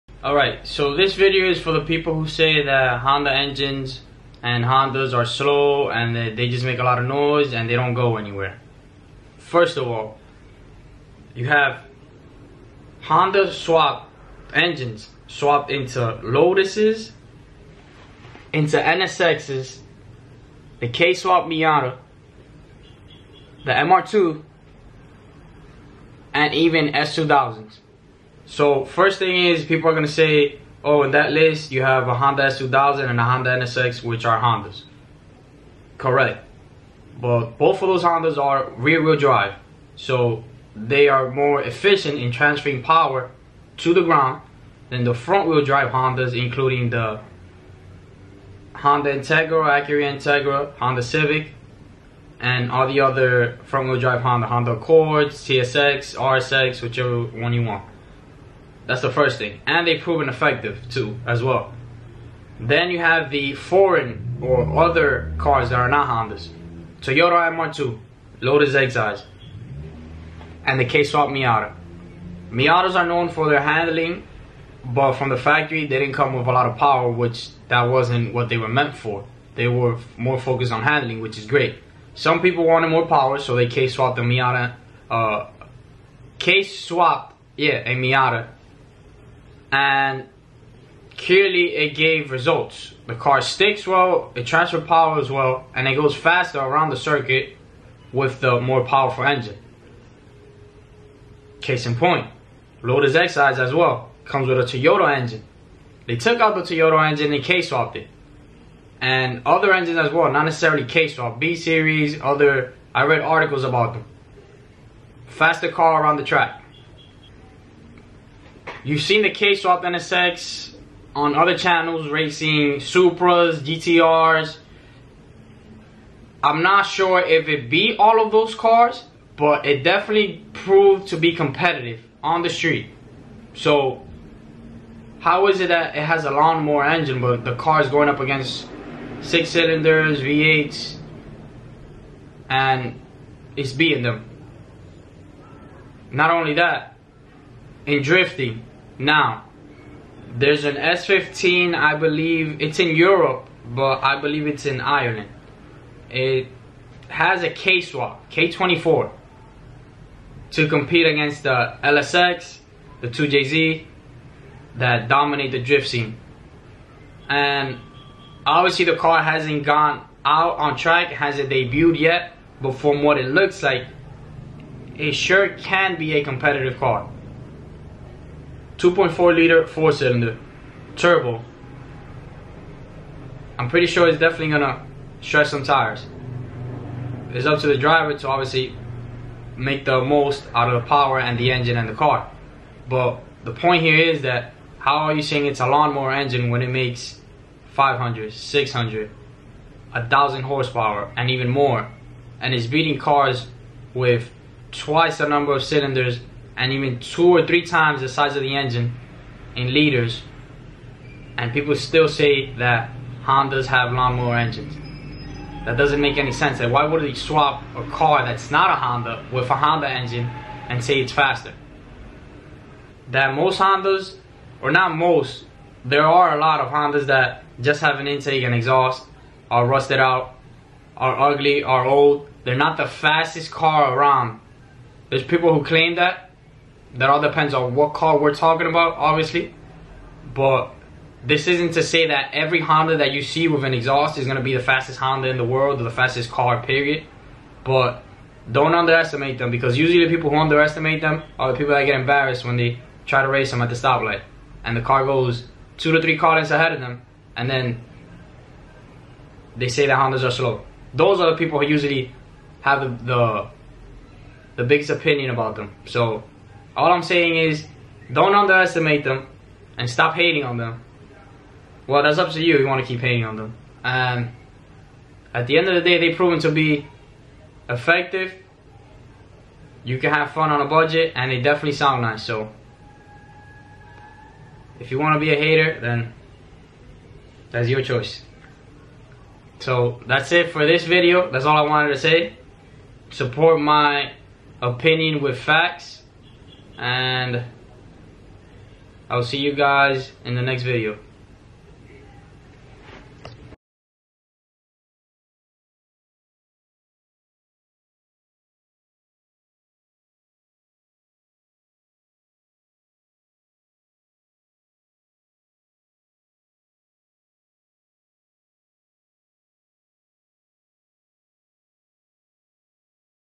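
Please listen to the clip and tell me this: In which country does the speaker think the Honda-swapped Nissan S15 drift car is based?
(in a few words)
Ireland.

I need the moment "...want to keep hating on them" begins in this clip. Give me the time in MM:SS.
04:32.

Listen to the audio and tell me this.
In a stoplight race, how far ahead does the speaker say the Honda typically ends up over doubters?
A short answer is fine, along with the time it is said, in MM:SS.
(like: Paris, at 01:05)
two to three car lengths, at 04:15.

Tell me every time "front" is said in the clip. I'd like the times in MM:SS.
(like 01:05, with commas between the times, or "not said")
00:45, 00:53.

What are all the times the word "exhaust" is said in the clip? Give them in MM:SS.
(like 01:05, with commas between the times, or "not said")
03:48, 04:03.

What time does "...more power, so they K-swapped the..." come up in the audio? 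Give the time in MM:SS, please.
01:22.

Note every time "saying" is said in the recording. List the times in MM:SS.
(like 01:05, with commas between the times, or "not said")
03:15, 04:27.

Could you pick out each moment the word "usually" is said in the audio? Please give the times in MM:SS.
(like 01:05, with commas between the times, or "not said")
04:09, 04:21.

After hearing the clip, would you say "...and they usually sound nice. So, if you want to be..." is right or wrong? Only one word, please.
wrong.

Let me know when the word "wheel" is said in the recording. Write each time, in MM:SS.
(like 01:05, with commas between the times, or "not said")
00:38, 00:45, 00:53.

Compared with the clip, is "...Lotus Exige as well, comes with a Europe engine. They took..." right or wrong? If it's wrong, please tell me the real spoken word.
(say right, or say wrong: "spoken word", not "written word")
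wrong: "Toyota", not "Europe".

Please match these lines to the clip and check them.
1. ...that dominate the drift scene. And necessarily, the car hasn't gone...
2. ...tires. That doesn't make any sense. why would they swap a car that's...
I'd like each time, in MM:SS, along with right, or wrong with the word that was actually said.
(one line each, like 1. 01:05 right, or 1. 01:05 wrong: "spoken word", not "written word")
1. 02:44 wrong: "obviously", not "necessarily"
2. 03:34 wrong: "engines", not "tires".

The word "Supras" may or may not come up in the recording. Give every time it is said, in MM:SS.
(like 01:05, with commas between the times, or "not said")
02:02.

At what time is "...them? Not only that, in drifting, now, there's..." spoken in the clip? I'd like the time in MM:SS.
02:24.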